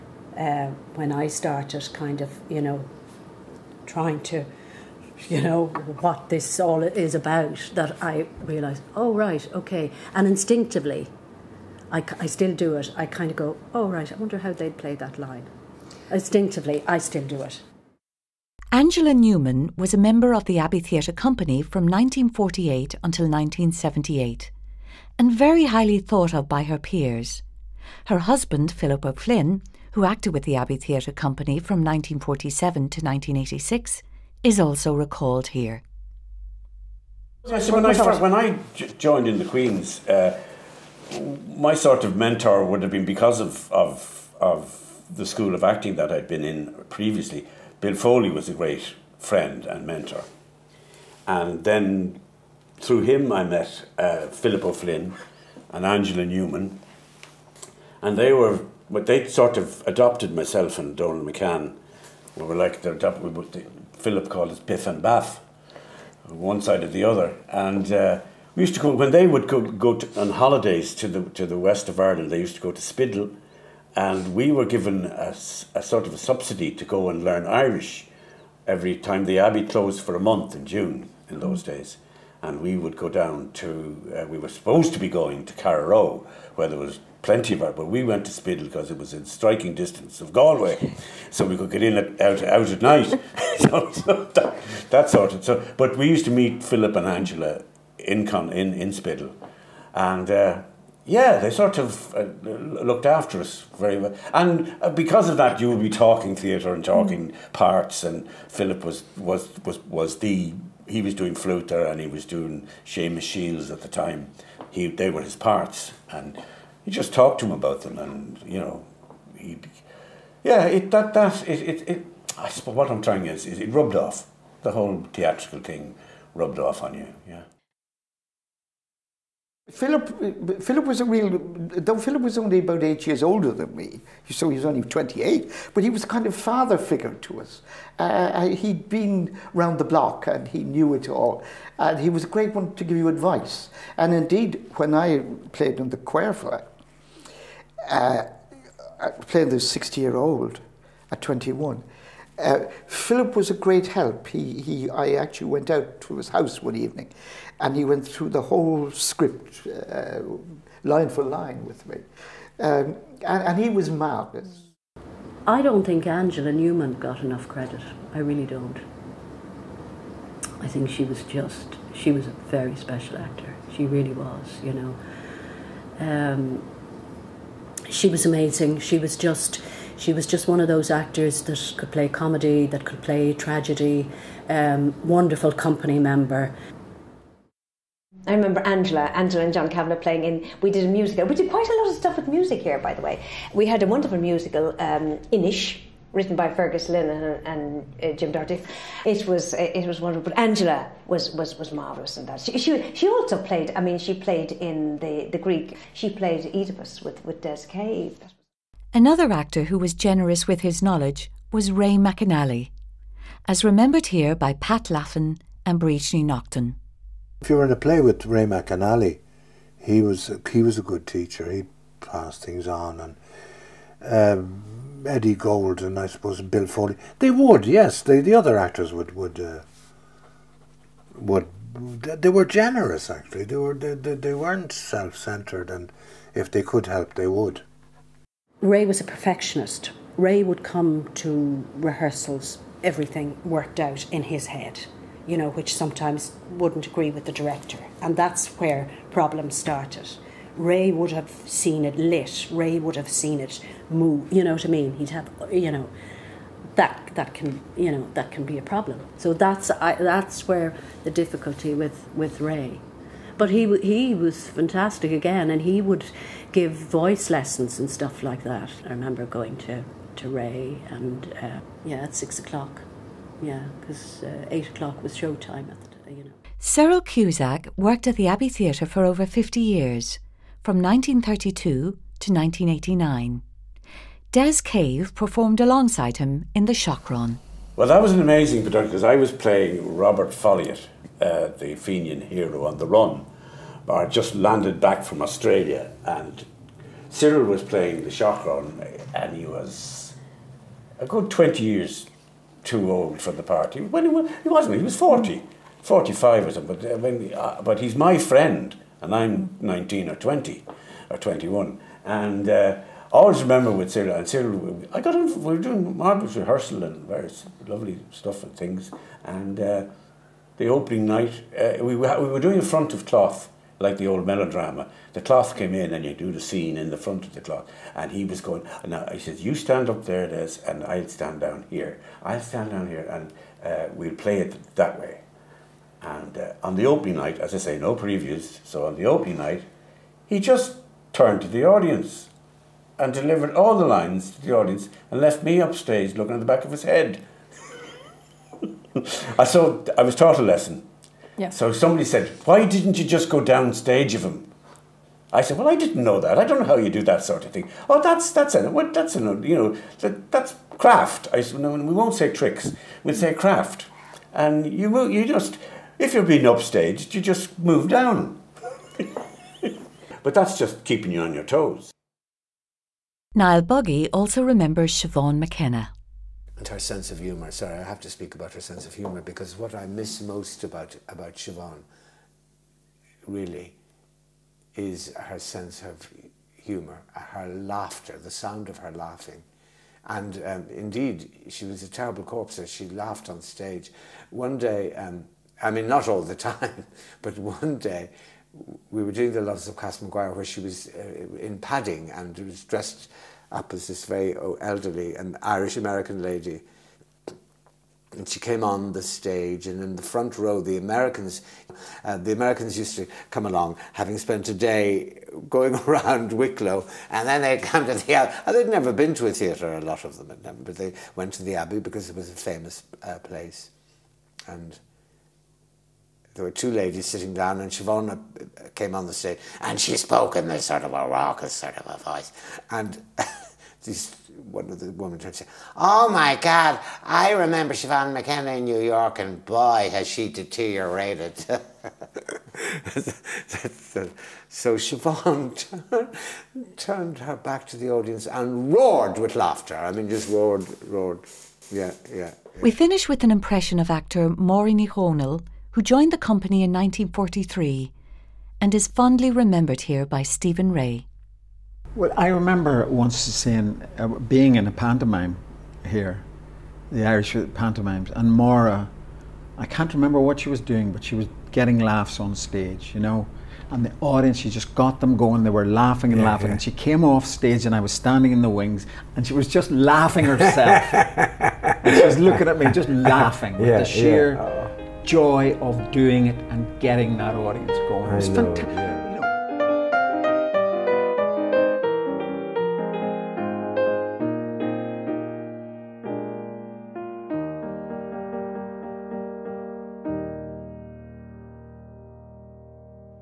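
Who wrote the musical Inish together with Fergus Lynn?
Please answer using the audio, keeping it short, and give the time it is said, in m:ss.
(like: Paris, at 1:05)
Jim Doherty, at 3:18.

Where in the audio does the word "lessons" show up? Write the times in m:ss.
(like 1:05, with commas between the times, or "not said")
4:27, 5:50.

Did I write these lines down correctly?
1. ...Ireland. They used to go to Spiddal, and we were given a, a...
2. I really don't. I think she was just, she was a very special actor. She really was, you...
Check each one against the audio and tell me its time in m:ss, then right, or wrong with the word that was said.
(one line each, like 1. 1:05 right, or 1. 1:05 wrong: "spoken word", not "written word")
1. 1:11 right
2. 2:48 right.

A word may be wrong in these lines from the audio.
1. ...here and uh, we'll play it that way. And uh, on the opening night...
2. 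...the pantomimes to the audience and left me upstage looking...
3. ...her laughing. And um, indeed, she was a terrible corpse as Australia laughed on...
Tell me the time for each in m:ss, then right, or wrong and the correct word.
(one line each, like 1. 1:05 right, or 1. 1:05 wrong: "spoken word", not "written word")
1. 5:32 right
2. 5:43 wrong: "lines", not "pantomimes"
3. 6:28 wrong: "She", not "Australia".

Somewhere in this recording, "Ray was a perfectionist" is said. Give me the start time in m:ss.
3:58.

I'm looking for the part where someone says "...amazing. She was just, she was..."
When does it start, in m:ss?
2:58.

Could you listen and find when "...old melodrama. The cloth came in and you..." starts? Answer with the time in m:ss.
5:24.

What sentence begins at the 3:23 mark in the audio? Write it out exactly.
I mean, she played in the the Greek.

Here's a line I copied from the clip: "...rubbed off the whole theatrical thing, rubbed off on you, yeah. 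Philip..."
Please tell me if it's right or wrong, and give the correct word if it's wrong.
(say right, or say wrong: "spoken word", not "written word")
right.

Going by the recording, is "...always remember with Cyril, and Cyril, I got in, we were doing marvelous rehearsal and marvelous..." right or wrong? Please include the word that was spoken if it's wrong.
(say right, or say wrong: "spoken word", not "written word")
wrong: "various", not "marvelous".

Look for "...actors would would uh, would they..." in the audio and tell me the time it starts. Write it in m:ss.
3:48.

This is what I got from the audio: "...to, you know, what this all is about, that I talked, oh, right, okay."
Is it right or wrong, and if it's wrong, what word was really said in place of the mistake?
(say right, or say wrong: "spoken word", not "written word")
wrong: "realised", not "talked".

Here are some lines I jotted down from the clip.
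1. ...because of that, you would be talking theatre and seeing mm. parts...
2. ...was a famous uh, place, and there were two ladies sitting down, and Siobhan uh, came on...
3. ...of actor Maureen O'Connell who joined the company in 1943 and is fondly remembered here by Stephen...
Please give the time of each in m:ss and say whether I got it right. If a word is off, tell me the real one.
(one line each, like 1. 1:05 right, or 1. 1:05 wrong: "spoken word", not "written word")
1. 1:44 wrong: "talking", not "seeing"
2. 7:02 right
3. 7:33 right.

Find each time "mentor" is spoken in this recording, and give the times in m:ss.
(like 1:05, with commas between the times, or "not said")
0:42, 0:49.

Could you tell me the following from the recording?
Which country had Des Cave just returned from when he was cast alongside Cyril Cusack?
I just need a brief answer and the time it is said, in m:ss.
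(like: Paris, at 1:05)
Australia, at 4:55.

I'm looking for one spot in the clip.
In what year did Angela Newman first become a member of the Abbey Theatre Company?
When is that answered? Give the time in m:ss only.
0:21.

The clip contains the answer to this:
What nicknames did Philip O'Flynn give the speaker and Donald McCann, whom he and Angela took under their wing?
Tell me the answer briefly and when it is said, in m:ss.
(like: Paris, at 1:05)
Piff and Baff, at 1:04.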